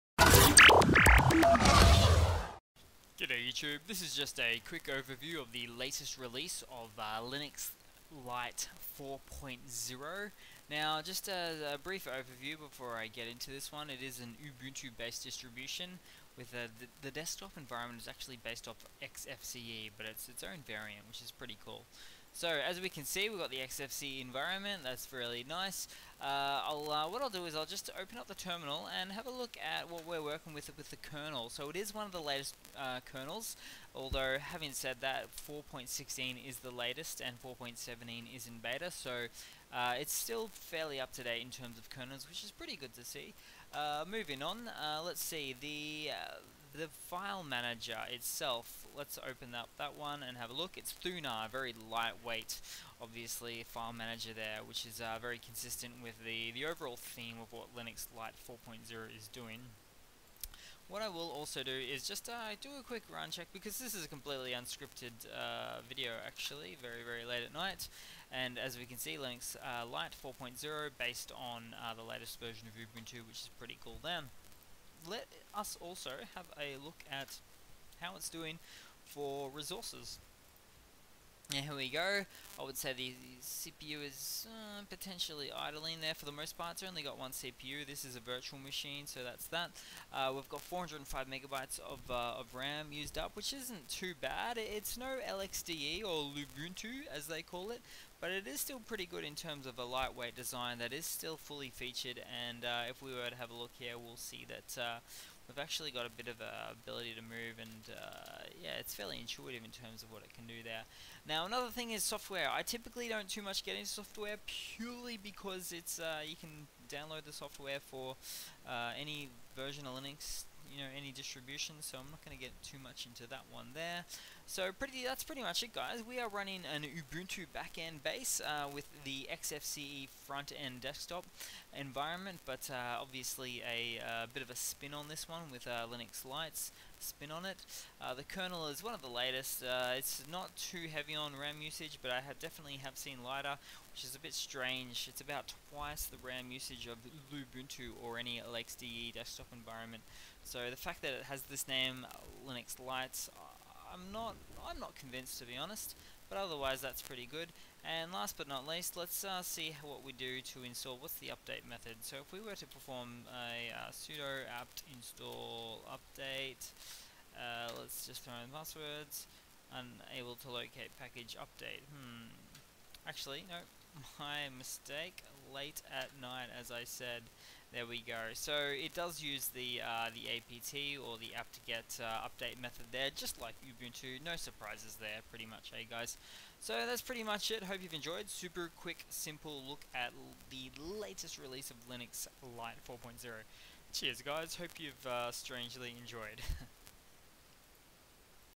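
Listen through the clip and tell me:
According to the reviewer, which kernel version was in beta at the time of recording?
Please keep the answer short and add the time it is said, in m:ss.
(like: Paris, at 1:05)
4.17, at 0:37.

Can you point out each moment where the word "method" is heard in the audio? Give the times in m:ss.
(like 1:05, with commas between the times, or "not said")
2:41, 3:02.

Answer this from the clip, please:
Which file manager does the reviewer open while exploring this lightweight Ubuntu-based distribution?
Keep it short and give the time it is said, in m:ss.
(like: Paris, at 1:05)
Thunar, at 0:50.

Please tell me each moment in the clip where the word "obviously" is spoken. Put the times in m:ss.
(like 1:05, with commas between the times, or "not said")
0:53, 2:13.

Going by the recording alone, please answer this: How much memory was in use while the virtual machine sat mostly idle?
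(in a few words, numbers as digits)
405 megabytes.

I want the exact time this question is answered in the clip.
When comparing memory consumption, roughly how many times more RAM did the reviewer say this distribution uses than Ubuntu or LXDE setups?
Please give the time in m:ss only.
2:25.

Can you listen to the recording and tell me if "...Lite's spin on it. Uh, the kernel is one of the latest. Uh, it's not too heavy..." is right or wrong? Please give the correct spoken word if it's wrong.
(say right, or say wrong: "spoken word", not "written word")
right.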